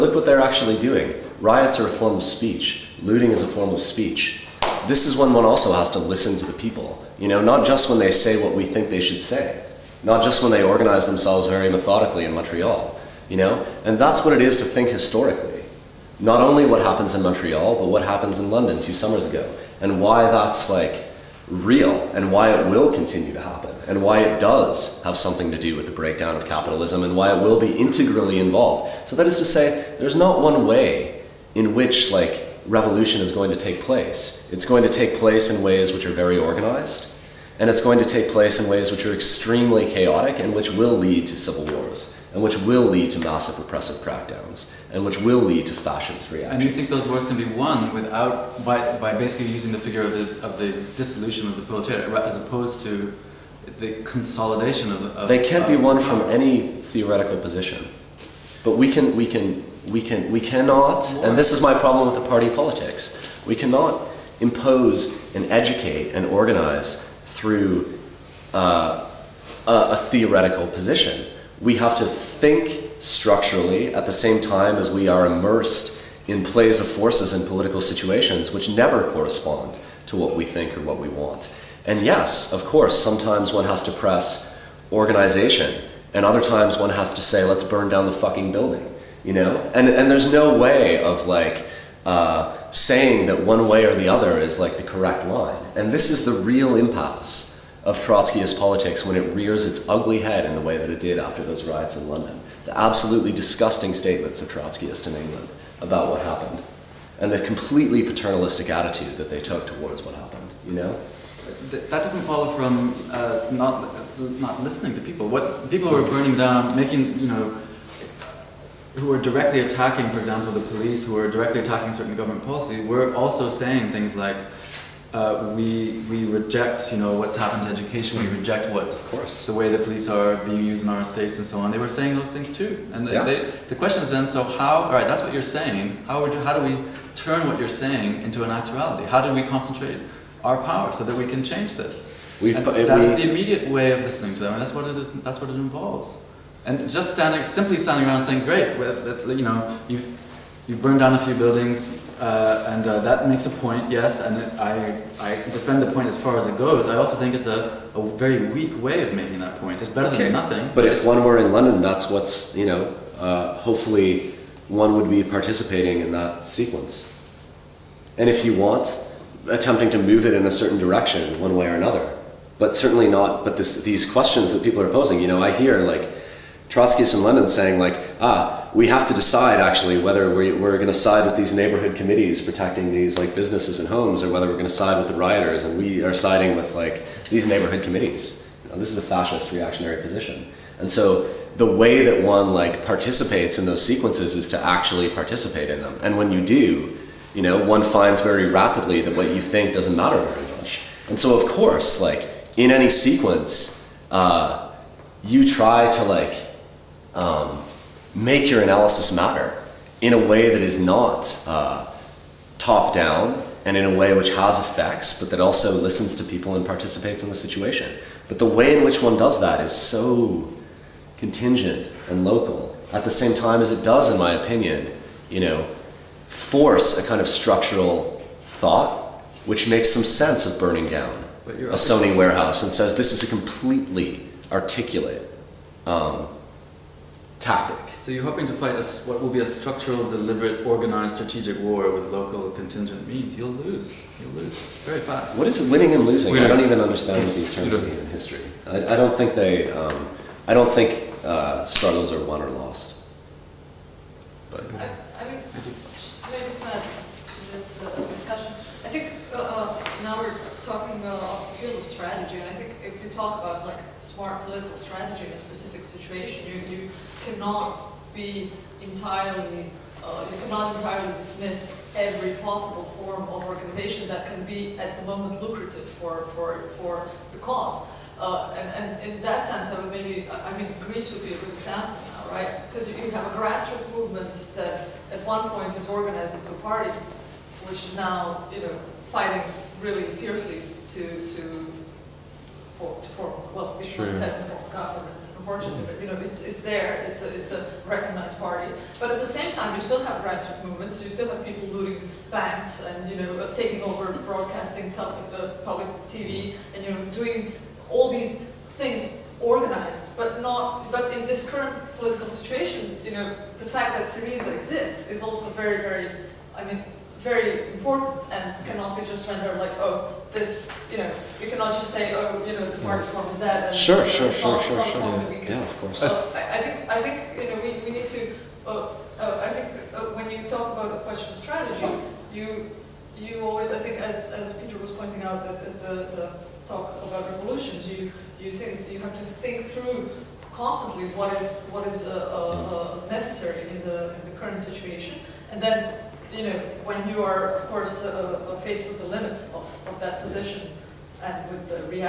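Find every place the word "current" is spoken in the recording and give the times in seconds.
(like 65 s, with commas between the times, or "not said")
311 s, 344 s.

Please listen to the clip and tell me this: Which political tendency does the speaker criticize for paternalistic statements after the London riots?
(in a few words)
Trotskyists.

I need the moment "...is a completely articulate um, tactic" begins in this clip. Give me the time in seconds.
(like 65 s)
233 s.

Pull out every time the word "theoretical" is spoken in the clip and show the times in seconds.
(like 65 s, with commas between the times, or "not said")
56 s, 69 s.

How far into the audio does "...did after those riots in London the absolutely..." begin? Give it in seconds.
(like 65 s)
101 s.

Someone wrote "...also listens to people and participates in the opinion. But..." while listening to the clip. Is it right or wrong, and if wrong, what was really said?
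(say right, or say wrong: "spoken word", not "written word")
wrong: "situation", not "opinion".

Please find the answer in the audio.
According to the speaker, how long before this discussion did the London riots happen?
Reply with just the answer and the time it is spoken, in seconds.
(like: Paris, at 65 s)
Two summers ago, at 18 s.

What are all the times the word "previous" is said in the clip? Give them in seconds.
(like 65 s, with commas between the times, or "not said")
not said.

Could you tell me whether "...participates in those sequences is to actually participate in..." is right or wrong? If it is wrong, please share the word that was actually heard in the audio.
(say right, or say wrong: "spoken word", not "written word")
right.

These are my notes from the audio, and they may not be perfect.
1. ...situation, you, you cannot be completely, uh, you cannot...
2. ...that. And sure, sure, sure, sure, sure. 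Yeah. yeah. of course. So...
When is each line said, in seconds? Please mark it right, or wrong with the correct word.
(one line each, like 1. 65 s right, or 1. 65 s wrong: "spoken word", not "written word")
1. 265 s wrong: "entirely", not "completely"
2. 323 s right.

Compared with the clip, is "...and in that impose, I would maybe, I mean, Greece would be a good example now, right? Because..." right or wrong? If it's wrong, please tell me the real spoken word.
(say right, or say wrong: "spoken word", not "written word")
wrong: "sense", not "impose".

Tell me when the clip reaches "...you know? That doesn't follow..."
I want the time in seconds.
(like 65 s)
110 s.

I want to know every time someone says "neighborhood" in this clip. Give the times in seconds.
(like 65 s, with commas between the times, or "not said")
181 s, 187 s.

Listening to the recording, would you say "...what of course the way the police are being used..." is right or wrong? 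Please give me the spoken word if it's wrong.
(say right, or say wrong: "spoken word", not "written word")
right.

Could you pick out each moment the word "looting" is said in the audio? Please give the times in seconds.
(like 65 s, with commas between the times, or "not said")
3 s, 301 s.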